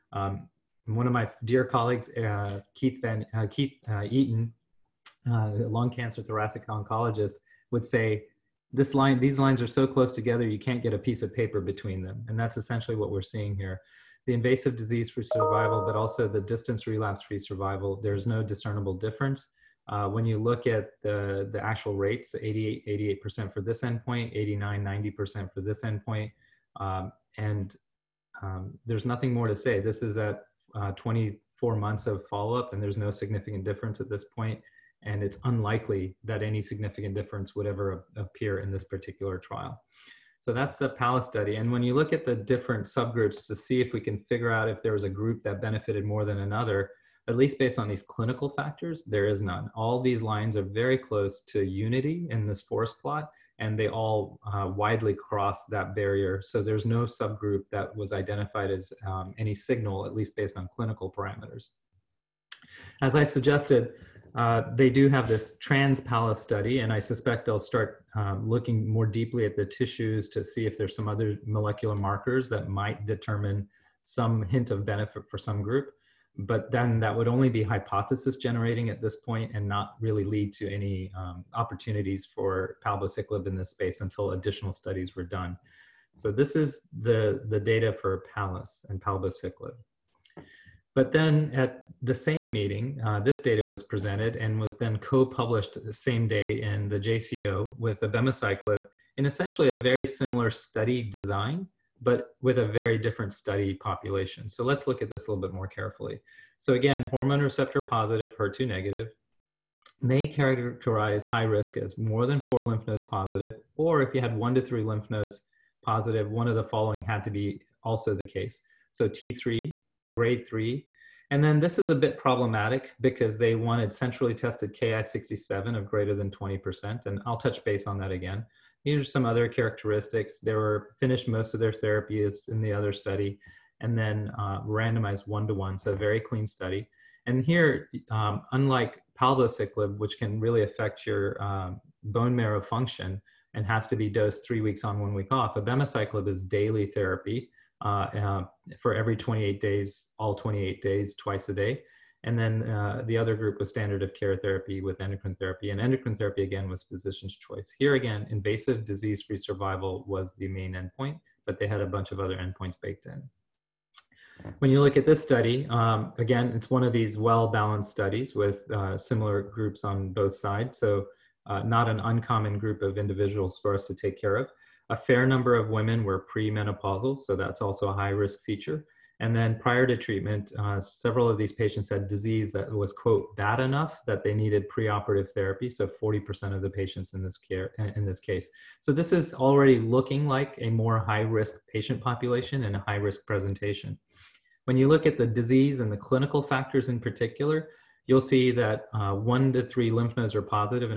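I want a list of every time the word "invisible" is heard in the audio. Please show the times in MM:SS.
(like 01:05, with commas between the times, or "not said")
not said.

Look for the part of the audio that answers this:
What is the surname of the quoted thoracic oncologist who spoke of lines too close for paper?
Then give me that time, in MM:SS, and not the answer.
00:04.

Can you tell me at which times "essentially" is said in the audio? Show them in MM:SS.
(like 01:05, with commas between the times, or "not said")
00:12, 01:39.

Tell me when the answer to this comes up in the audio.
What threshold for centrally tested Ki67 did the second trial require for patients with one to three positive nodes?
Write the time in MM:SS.
02:05.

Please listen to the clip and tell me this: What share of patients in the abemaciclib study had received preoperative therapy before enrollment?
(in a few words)
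40%.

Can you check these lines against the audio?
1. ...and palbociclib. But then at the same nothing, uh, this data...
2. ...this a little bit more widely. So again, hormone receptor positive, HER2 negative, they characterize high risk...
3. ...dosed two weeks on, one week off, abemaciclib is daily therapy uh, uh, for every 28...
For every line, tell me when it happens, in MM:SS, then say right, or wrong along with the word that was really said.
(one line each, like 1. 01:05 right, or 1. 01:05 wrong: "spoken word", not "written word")
1. 01:28 wrong: "meeting", not "nothing"
2. 01:45 wrong: "carefully", not "widely"
3. 02:24 wrong: "three", not "two".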